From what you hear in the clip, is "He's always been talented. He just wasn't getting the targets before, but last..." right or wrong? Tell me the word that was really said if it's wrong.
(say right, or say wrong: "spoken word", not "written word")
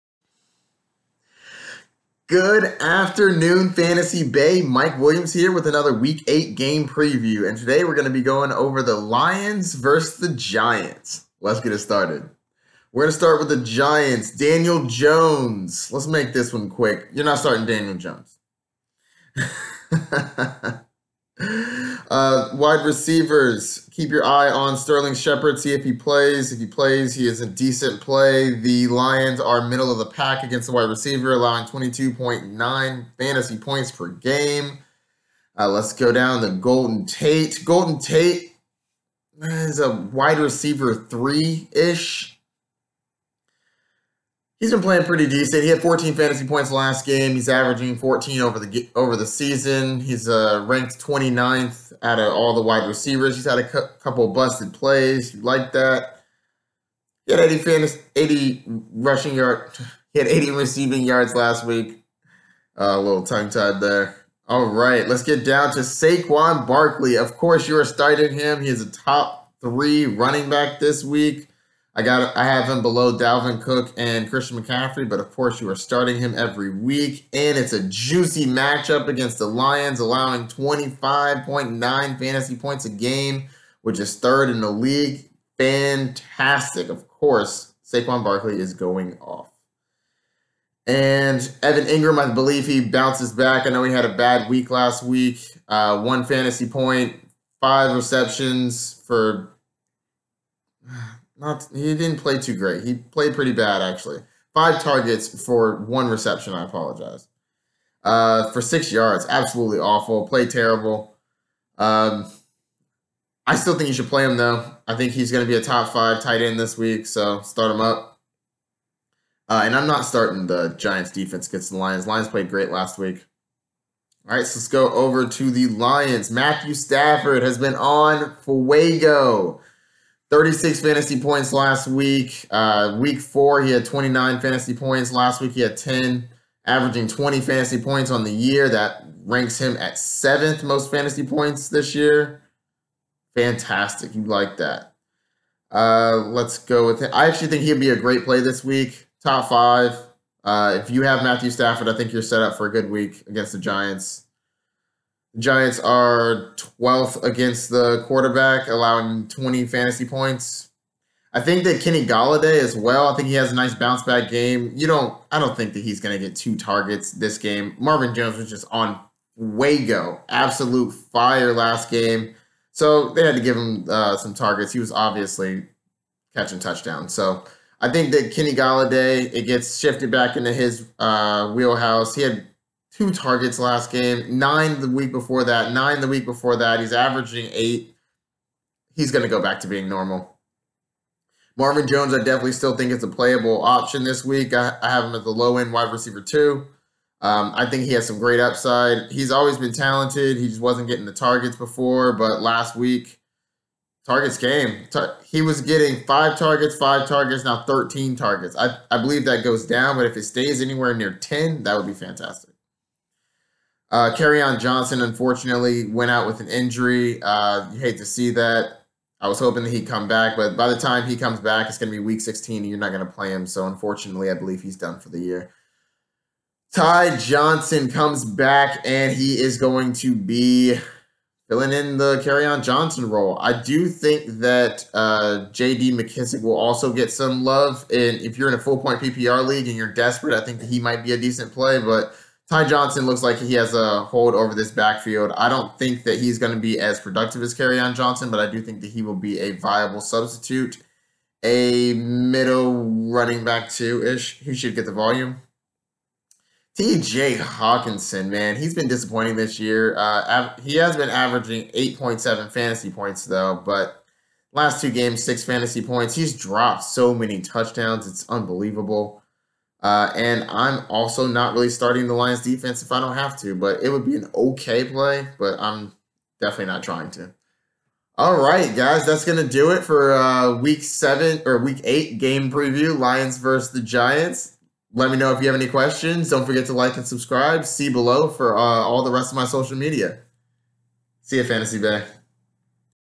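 right.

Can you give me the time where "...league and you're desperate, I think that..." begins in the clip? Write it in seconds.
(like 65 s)
239 s.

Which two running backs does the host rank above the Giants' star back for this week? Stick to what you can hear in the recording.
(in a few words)
Dalvin Cook and Christian McCaffrey.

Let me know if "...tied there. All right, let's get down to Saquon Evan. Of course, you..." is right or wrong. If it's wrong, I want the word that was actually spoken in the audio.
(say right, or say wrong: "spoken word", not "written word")
wrong: "Barkley", not "Evan".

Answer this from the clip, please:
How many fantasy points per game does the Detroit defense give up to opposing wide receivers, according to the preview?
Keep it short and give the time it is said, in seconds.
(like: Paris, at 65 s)
22.9, at 31 s.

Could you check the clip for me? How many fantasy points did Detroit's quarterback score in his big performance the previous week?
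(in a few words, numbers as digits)
36.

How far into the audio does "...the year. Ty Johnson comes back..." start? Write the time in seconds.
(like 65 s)
225 s.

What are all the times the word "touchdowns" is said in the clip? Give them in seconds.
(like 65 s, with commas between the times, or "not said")
176 s, 267 s.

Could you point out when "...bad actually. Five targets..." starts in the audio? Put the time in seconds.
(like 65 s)
103 s.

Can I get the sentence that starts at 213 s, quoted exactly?
Uh, on Johnson, unfortunately, went out with an injury.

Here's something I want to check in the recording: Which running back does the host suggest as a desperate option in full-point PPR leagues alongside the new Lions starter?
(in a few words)
JD McKissic.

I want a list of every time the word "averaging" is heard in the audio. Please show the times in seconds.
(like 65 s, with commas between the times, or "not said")
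47 s, 136 s, 186 s, 261 s.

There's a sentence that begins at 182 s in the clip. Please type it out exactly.
He had two targets last game, nine the week before that, nine the week before that.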